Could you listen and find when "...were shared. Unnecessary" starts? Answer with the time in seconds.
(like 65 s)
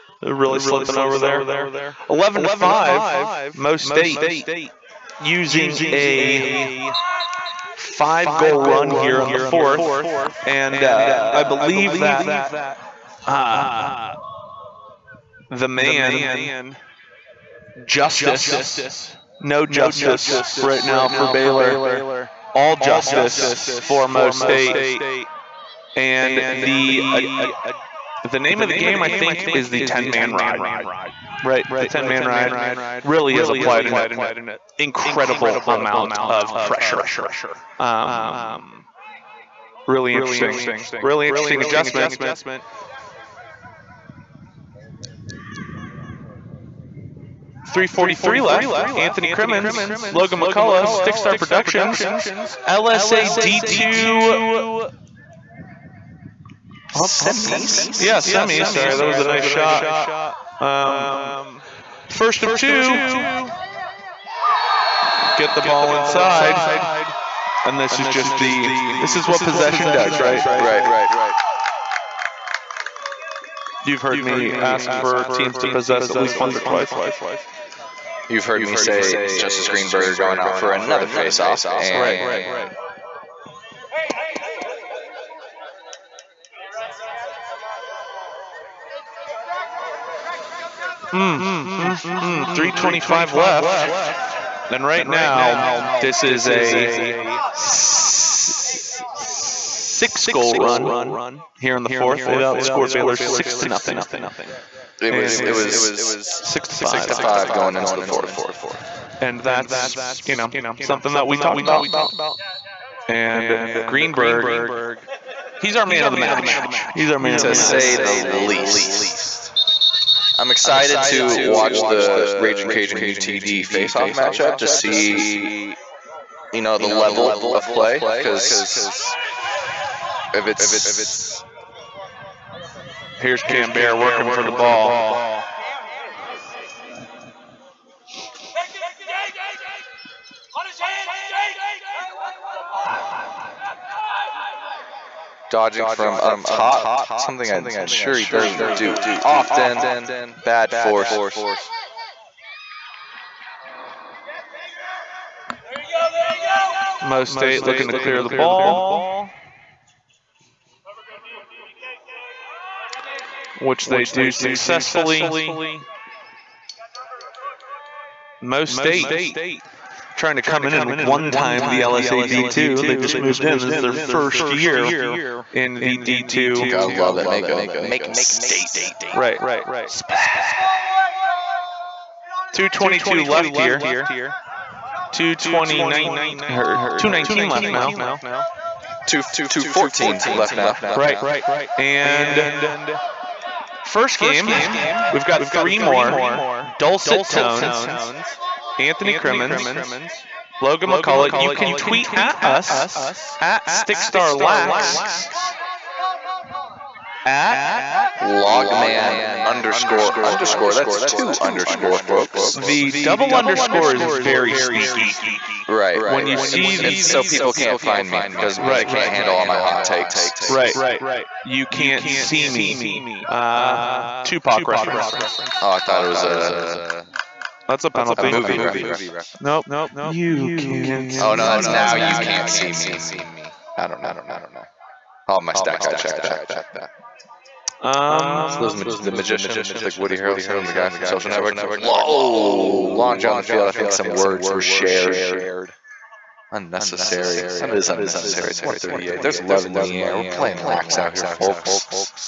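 244 s.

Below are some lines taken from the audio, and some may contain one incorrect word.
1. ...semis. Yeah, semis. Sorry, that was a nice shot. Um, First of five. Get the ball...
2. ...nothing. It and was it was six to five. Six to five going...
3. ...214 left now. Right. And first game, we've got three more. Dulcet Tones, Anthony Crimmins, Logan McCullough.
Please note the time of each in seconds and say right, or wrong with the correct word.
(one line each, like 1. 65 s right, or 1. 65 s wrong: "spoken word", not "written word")
1. 57 s wrong: "two", not "five"
2. 103 s right
3. 189 s right.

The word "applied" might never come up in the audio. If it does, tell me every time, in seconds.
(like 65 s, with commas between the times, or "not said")
33 s.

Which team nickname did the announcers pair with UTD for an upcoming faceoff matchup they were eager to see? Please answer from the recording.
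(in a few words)
Raging Cajun.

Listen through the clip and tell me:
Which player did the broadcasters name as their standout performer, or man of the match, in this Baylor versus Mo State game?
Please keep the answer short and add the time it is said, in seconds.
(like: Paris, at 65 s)
Greenberger, at 113 s.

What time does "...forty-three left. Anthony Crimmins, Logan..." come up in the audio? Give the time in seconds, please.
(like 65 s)
47 s.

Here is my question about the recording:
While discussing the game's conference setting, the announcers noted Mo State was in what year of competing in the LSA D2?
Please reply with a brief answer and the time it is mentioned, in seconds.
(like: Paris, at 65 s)
first year, at 173 s.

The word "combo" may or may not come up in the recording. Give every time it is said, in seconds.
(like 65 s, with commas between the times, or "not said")
not said.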